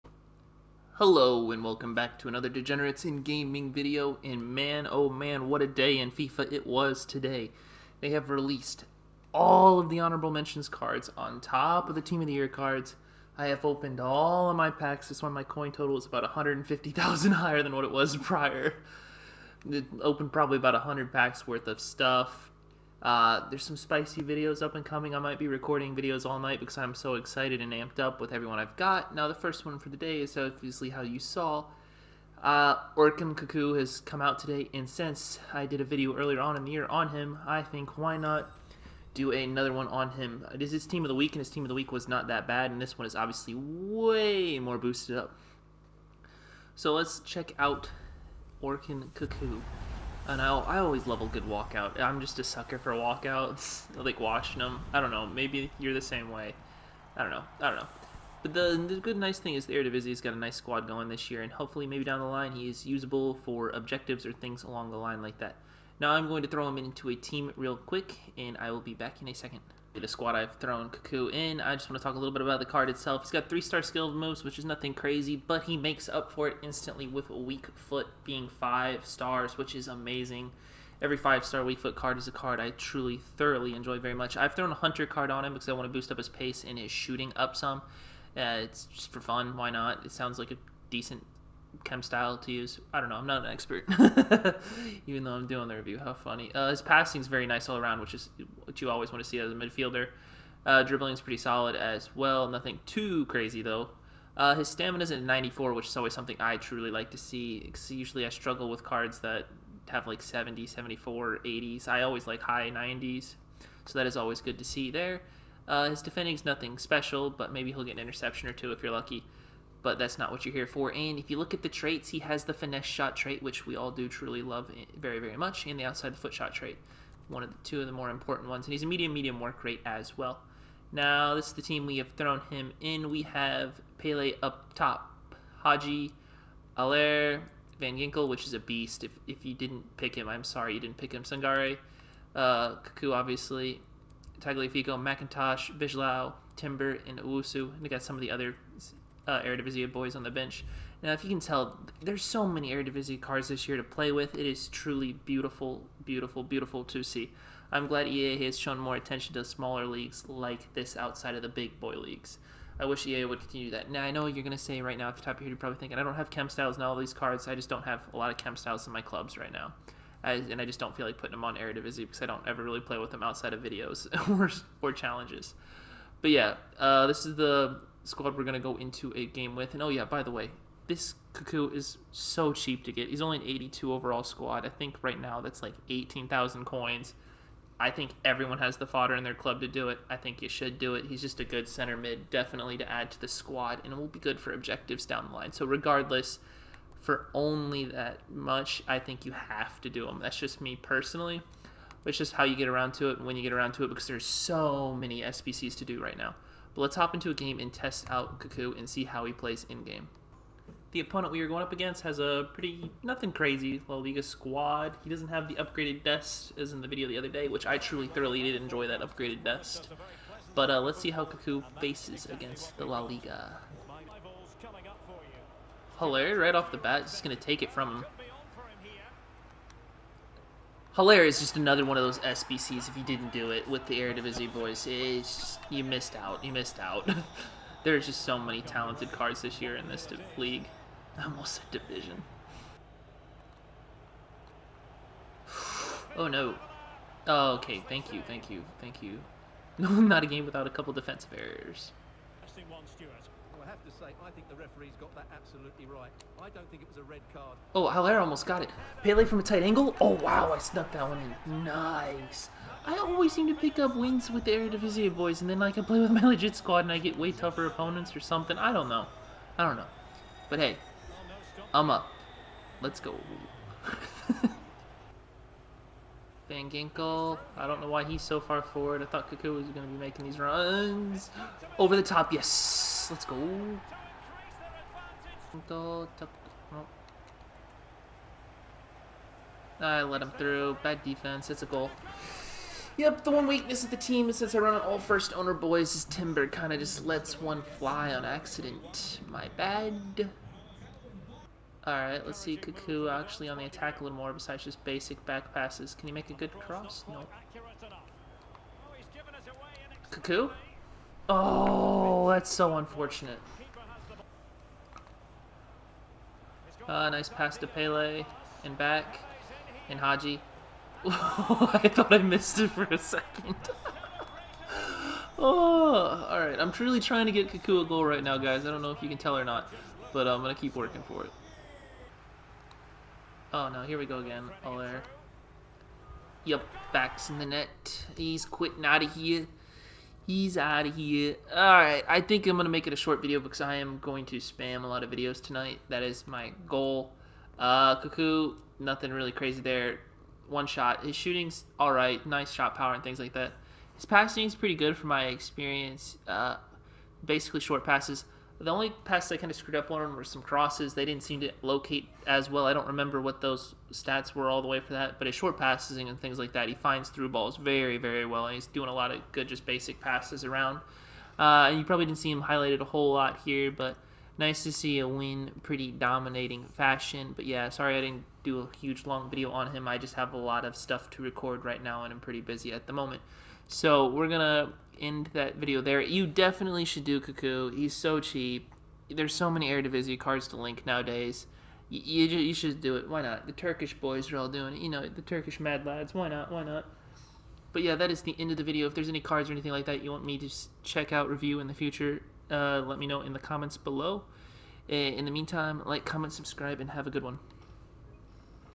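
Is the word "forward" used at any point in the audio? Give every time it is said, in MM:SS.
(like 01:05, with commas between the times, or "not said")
04:38.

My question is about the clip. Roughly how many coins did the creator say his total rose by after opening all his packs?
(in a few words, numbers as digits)
150,000.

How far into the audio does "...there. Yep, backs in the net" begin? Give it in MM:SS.
05:34.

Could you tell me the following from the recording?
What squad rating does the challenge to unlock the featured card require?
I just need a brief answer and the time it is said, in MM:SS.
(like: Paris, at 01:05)
82, at 03:03.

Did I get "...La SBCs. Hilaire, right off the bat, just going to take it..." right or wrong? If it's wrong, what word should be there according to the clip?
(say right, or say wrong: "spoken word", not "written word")
wrong: "Liga", not "SBCs".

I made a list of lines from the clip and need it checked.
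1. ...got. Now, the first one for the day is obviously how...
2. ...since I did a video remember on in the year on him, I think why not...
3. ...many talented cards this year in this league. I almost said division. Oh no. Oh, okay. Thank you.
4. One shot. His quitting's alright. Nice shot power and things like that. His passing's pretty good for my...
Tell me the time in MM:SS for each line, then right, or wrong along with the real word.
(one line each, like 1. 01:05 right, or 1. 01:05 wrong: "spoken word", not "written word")
1. 00:28 right
2. 00:34 wrong: "earlier", not "remember"
3. 03:58 right
4. 05:50 wrong: "shooting", not "quitting".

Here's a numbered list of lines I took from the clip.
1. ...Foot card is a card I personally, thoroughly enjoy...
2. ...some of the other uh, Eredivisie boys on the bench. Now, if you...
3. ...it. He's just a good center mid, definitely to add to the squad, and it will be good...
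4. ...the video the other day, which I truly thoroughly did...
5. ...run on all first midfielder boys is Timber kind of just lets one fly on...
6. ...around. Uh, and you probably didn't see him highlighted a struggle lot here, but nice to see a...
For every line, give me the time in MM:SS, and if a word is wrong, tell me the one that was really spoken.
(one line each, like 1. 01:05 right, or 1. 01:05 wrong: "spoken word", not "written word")
1. 01:21 wrong: "truly", not "personally"
2. 02:28 right
3. 03:10 right
4. 03:36 right
5. 04:54 wrong: "owner", not "midfielder"
6. 06:10 wrong: "whole", not "struggle".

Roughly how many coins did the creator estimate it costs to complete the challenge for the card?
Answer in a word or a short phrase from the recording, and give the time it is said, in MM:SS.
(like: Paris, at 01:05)
18,000, at 03:05.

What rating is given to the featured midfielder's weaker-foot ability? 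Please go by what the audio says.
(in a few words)
5 stars.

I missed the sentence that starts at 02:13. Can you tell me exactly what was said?
We have Pele up top, Hagi, Allaire, Van Ginkel, which is a beast.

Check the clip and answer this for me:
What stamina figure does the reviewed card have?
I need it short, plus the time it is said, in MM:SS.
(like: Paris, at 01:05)
94, at 01:45.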